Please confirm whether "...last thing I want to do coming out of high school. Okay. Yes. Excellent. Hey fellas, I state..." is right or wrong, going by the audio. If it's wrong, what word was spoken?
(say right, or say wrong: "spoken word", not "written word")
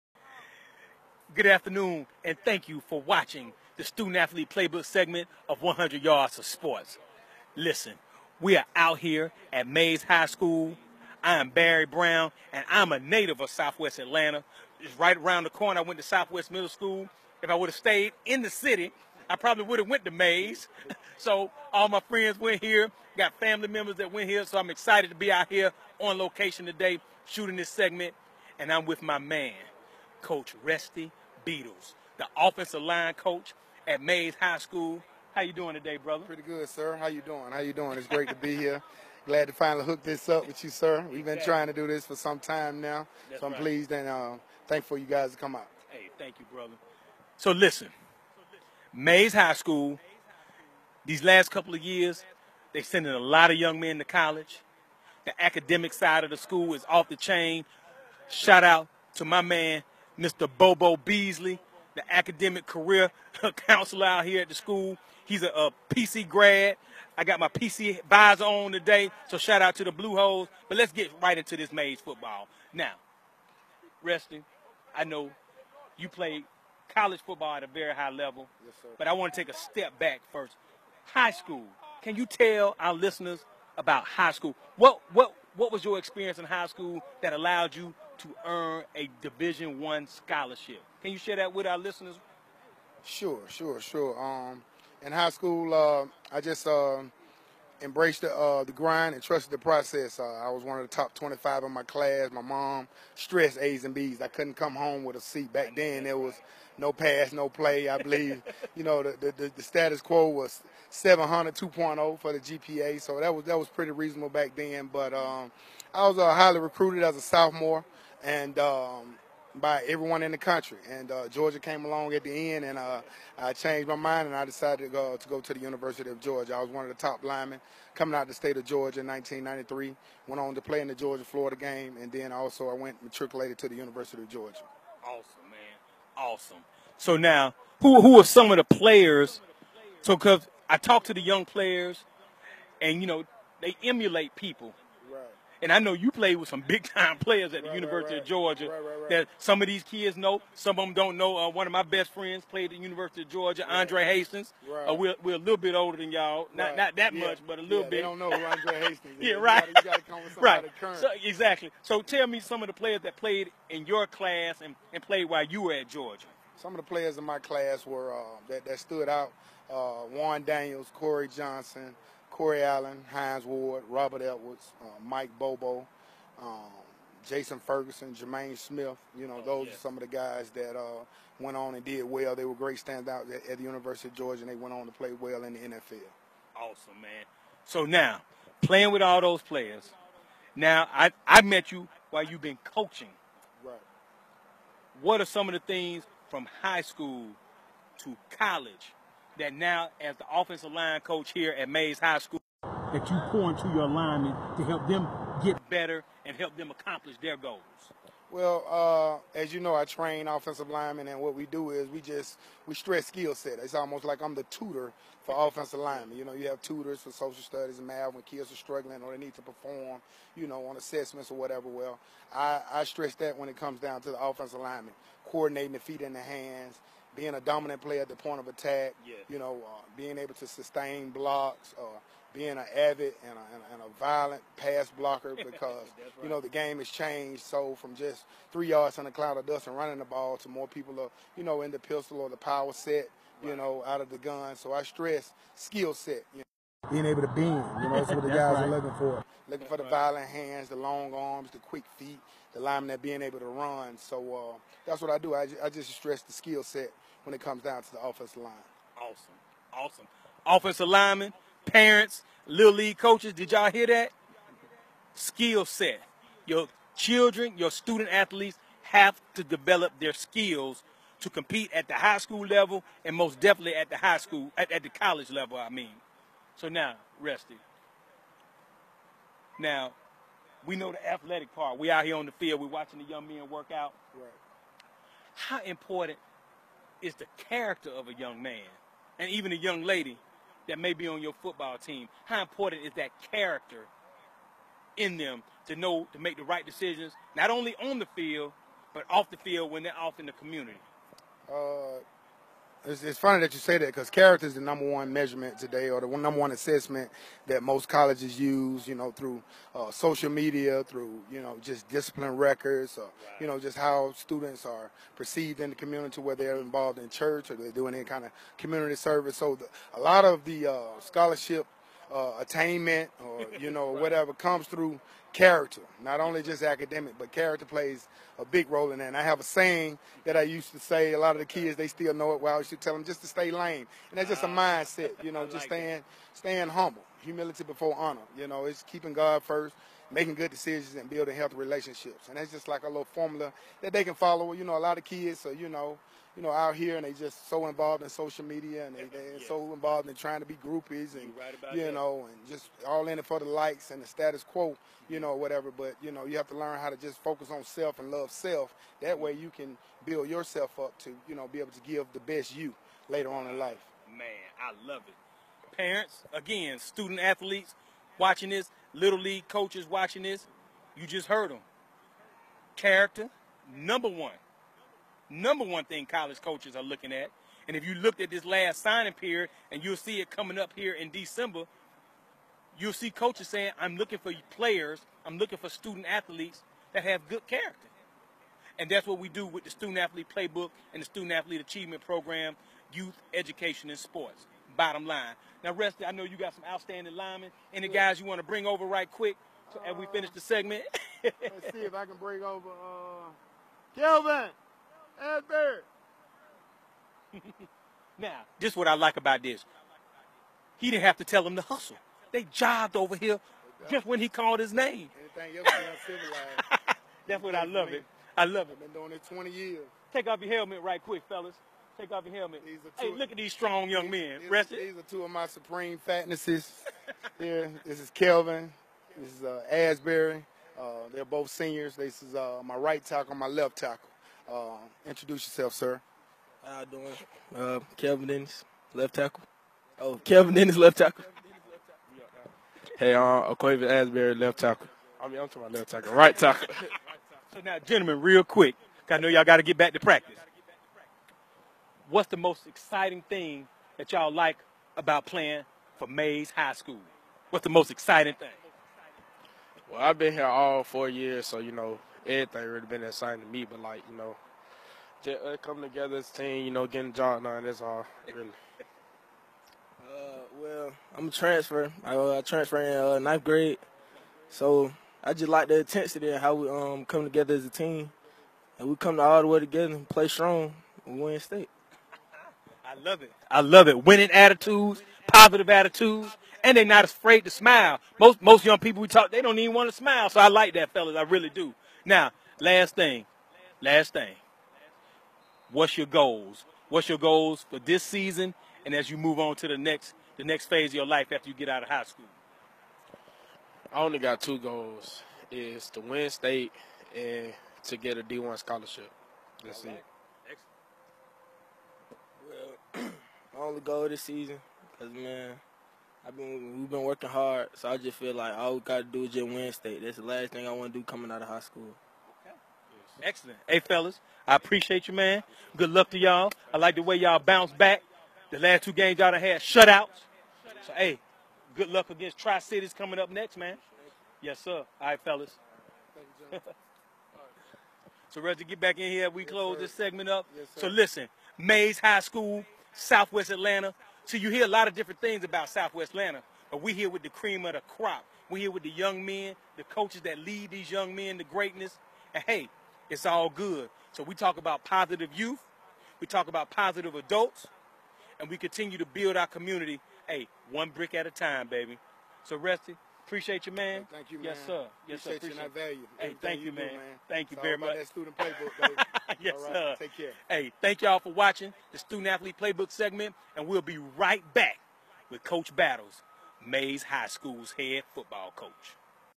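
wrong: "appreciate", not "state".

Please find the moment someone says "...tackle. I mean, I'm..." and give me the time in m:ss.
7:24.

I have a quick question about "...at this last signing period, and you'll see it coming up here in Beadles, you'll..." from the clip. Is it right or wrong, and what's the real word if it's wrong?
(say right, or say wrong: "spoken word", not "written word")
wrong: "December", not "Beadles".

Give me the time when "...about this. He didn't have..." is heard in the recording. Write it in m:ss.
6:49.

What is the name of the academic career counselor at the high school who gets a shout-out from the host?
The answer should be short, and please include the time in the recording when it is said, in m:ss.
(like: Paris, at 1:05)
Bobo Beasley, at 1:00.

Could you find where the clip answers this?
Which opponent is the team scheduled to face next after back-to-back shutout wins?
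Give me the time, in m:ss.
8:52.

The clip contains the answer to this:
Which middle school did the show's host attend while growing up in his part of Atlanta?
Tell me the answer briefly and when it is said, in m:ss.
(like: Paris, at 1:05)
Southwest Middle School, at 0:16.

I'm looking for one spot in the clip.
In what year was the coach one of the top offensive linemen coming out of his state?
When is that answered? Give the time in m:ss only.
2:09.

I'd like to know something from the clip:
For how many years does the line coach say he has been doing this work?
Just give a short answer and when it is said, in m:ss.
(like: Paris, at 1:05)
20, at 6:59.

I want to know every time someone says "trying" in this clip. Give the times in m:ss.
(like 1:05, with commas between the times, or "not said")
0:41, 5:50.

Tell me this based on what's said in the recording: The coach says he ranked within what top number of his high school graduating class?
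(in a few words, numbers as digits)
25.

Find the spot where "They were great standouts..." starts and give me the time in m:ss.
3:02.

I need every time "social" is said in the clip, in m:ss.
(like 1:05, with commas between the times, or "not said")
3:37, 5:09, 5:48.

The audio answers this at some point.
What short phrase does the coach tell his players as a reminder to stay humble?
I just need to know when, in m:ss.
5:33.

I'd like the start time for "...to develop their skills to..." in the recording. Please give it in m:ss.
4:29.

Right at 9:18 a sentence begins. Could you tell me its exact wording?
And we continue to build our community, hey, one brick at a time, baby.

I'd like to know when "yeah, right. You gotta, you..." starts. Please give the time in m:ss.
2:39.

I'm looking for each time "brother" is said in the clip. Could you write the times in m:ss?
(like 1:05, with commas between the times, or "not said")
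0:35, 0:46.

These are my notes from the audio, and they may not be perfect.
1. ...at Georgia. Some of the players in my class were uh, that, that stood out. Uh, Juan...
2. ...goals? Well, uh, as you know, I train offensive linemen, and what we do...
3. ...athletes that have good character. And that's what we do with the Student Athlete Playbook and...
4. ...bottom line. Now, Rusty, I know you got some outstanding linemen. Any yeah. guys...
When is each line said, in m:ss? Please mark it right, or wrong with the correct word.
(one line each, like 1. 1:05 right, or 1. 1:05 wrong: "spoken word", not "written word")
1. 2:45 right
2. 3:27 right
3. 6:26 right
4. 6:34 right.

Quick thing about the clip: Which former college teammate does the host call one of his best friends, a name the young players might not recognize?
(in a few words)
Andre Hastings.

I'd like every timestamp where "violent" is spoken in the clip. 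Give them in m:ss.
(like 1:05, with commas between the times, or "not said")
3:53, 4:09.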